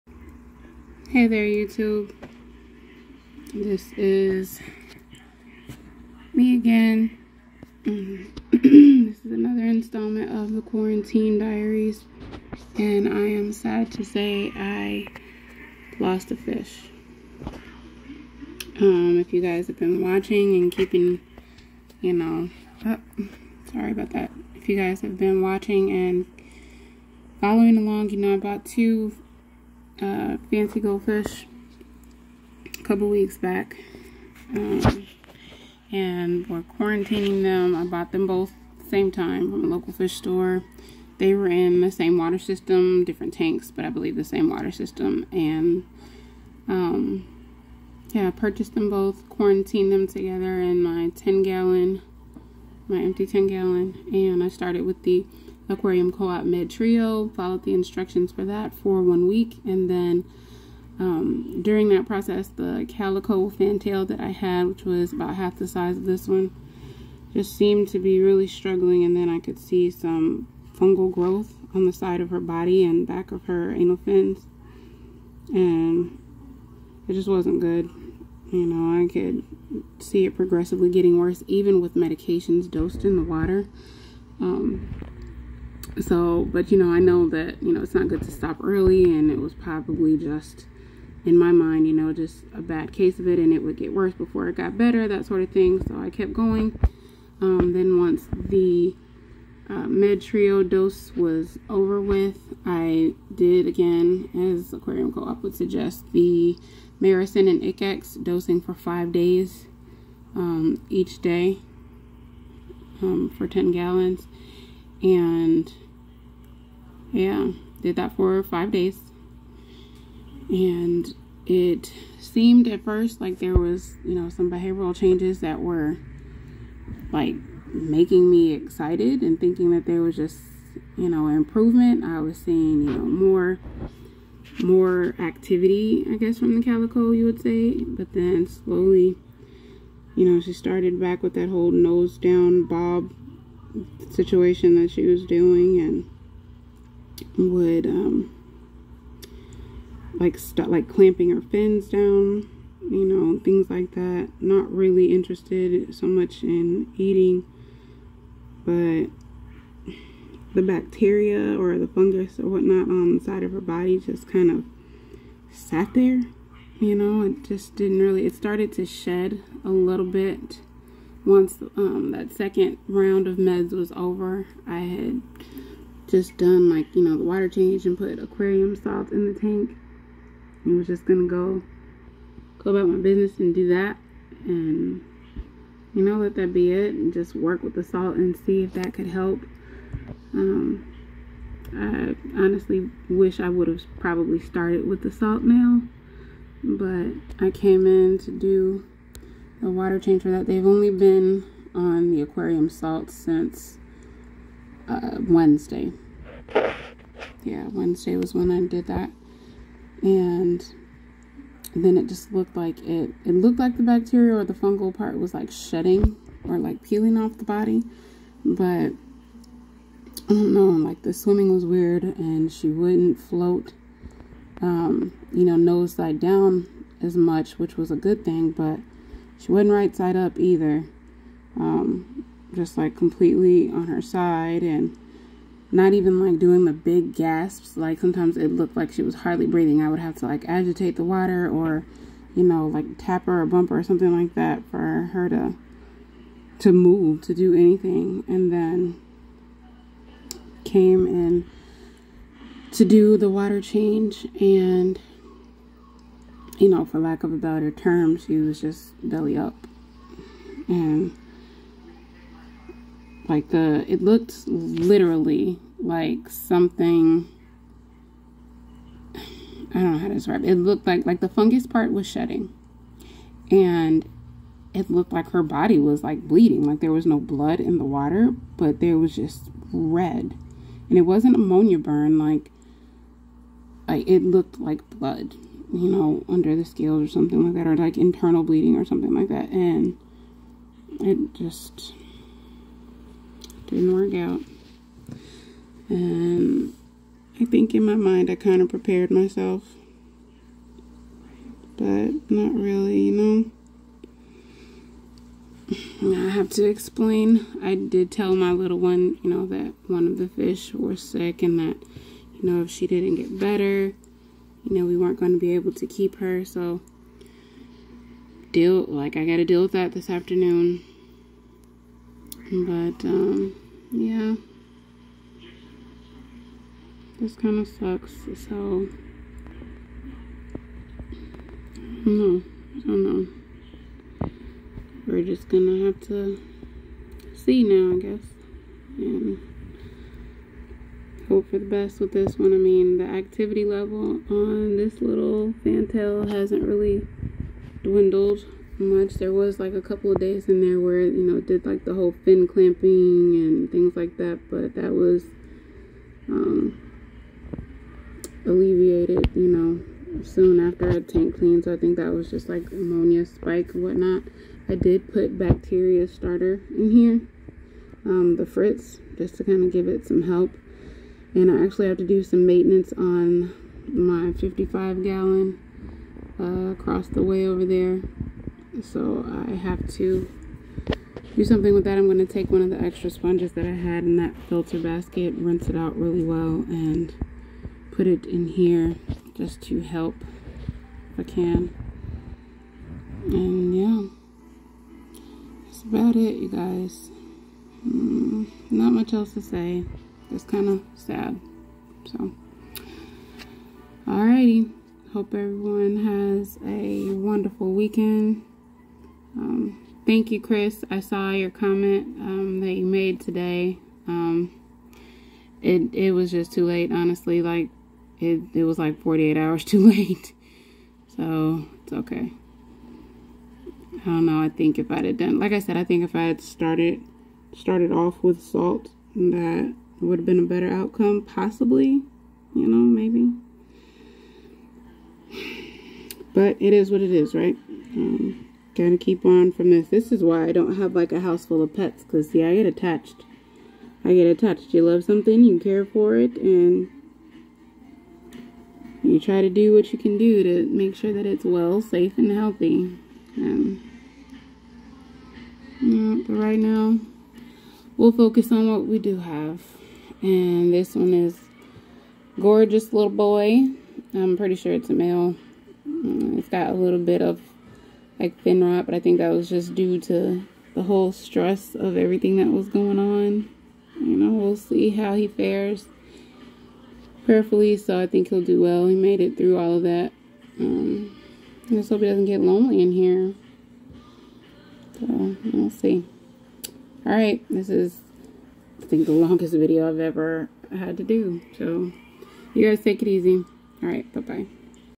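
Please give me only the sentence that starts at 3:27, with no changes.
Yeah, Wednesday was when I did that.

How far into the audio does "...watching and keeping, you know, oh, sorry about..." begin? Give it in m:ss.
0:20.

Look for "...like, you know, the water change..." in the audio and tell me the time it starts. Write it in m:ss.
2:56.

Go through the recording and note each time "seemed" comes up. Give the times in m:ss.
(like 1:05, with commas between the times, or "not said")
1:07, 2:02.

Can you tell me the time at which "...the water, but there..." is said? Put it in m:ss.
4:37.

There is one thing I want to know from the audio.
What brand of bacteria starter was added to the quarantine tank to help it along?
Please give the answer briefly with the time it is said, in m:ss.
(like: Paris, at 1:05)
Fritz, at 6:08.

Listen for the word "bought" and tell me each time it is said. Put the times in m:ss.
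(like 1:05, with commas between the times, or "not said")
0:28, 0:37.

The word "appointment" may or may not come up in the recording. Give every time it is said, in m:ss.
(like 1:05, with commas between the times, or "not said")
not said.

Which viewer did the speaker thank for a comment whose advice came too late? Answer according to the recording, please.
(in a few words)
Chris.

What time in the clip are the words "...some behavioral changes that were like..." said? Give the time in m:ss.
2:04.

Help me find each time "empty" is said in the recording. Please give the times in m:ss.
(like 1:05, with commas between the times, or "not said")
0:52.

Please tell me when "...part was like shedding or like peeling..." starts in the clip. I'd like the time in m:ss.
3:34.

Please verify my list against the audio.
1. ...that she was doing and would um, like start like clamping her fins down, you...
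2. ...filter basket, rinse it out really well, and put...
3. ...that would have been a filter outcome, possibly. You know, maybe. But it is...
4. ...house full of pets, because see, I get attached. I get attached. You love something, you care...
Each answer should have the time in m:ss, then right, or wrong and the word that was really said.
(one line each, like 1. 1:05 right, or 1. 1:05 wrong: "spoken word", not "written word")
1. 2:24 right
2. 6:24 right
3. 7:09 wrong: "better", not "filter"
4. 7:21 right.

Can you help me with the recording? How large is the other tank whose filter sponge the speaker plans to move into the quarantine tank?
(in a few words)
55 gallon.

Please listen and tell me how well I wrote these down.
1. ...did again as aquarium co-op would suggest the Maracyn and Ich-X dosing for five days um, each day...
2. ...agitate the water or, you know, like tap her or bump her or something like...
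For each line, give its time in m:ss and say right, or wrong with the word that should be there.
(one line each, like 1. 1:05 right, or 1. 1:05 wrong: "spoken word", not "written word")
1. 1:43 right
2. 4:00 right.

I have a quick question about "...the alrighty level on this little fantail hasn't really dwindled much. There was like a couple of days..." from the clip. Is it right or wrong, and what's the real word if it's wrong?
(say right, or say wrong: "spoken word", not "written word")
wrong: "activity", not "alrighty".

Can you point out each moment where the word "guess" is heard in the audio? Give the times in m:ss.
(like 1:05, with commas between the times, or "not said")
2:16, 5:37.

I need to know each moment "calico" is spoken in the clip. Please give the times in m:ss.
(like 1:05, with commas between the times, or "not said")
1:02, 2:16.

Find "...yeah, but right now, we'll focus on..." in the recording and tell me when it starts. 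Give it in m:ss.
7:35.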